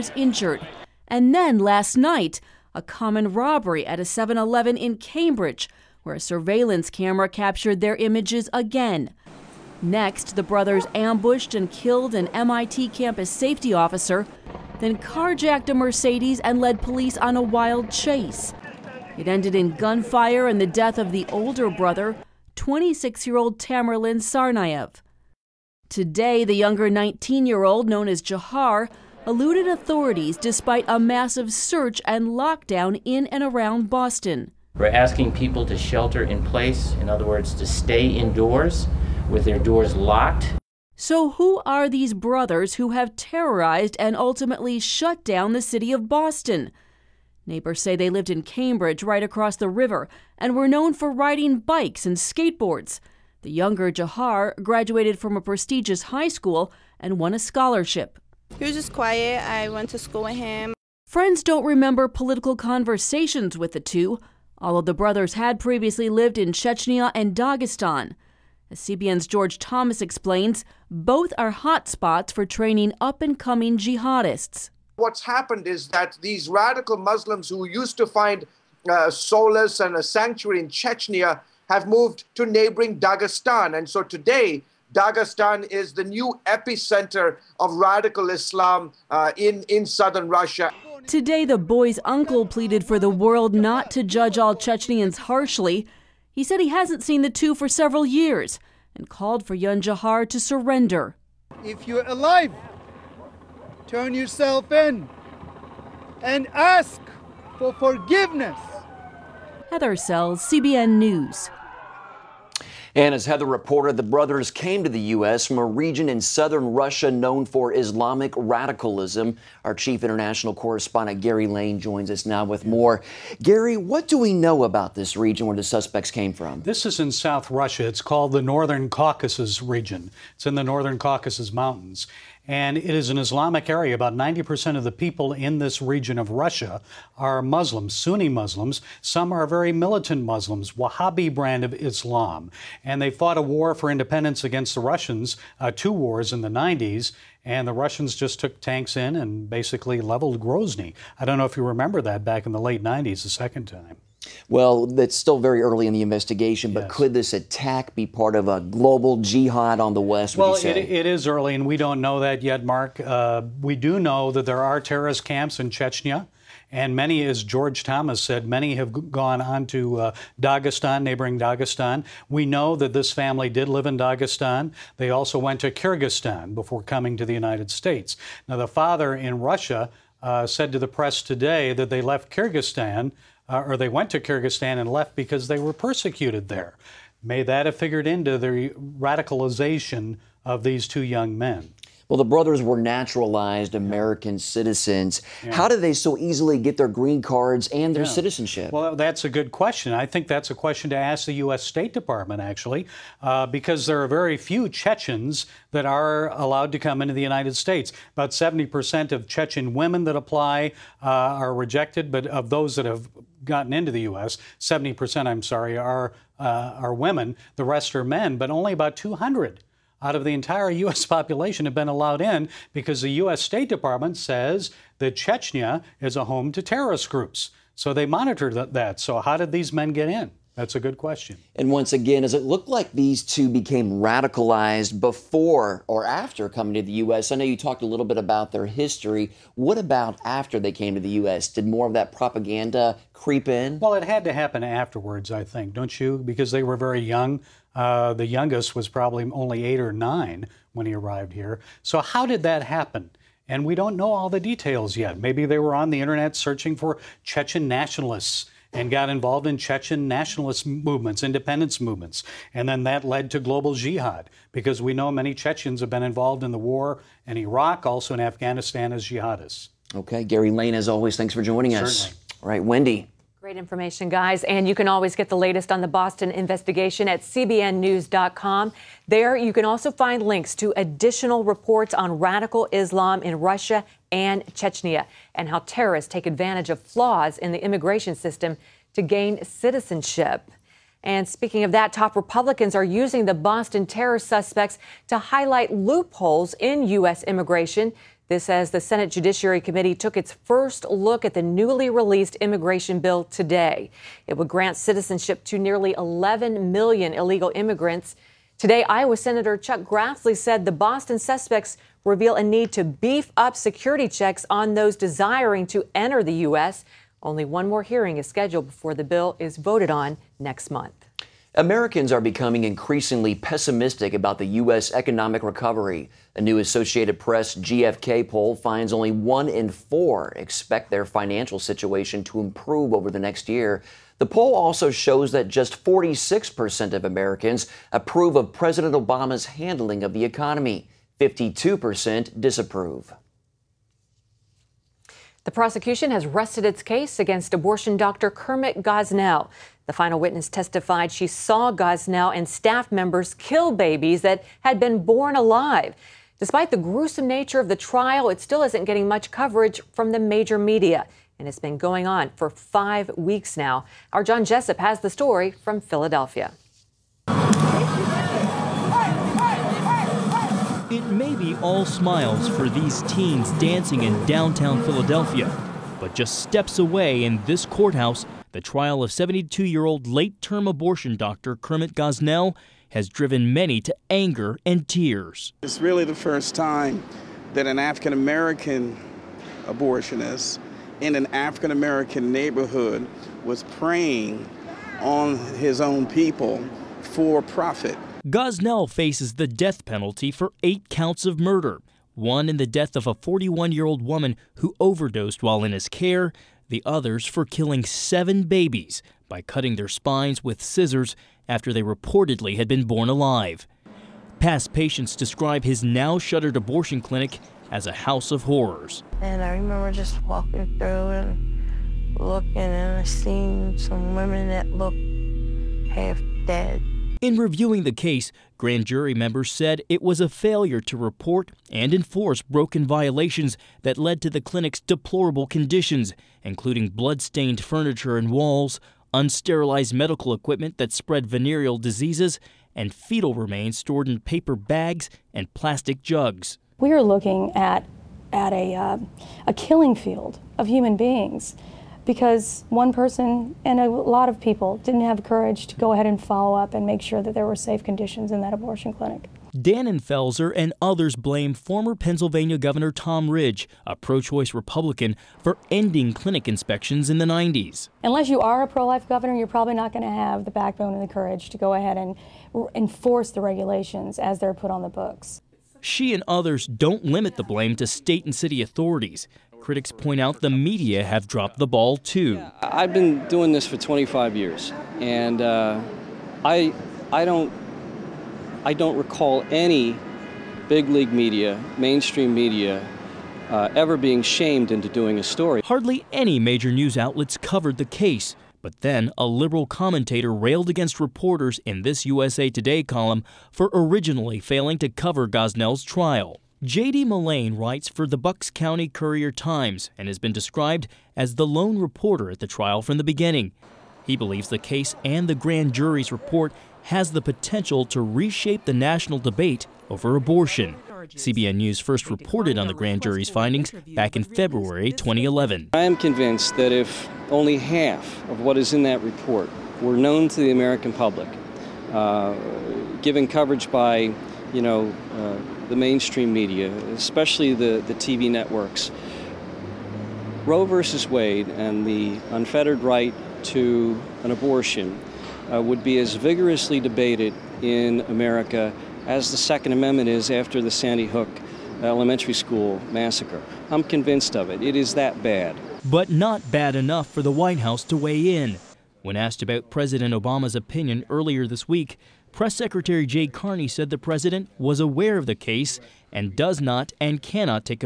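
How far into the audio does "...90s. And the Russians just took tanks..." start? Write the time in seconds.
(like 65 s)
146 s.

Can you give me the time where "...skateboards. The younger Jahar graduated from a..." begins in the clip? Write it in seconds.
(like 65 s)
52 s.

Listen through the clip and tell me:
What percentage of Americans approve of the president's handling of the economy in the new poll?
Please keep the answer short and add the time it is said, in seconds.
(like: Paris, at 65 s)
46%, at 335 s.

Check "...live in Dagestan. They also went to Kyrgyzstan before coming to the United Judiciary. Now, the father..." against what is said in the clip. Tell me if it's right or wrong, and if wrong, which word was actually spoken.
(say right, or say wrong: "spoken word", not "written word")
wrong: "States", not "Judiciary".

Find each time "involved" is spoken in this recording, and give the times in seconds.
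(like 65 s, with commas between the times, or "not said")
259 s, 266 s.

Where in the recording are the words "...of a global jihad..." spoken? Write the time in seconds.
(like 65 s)
158 s.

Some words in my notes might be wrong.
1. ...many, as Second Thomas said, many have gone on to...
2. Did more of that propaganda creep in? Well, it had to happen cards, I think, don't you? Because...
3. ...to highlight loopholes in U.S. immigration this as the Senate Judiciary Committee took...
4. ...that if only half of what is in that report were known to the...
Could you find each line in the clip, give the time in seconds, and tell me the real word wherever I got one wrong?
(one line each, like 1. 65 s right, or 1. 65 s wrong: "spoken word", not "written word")
1. 166 s wrong: "George", not "Second"
2. 241 s wrong: "afterwards", not "cards"
3. 295 s right
4. 526 s right.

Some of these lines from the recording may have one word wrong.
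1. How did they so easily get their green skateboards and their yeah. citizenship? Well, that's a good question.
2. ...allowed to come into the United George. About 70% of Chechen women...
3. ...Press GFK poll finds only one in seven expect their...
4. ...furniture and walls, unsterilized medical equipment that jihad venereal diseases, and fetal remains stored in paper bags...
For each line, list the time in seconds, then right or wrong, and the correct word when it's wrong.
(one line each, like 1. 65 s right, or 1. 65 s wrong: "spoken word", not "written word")
1. 195 s wrong: "cards", not "skateboards"
2. 206 s wrong: "States", not "George"
3. 327 s wrong: "four", not "seven"
4. 437 s wrong: "spread", not "jihad".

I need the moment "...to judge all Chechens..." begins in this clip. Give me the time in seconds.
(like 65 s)
93 s.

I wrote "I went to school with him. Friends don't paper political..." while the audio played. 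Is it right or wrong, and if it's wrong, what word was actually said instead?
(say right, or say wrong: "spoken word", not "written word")
wrong: "remember", not "paper".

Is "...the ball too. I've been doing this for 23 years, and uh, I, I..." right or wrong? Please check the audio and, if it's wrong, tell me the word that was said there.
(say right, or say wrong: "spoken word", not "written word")
wrong: "25", not "23".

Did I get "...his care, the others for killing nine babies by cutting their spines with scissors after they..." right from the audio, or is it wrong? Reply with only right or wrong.
wrong.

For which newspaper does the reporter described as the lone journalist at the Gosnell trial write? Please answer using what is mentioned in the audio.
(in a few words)
Bucks County Courier Times.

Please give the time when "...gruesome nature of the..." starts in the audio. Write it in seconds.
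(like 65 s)
356 s.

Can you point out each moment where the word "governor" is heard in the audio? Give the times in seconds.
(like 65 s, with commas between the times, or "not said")
462 s, 469 s.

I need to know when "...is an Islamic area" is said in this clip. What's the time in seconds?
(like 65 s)
132 s.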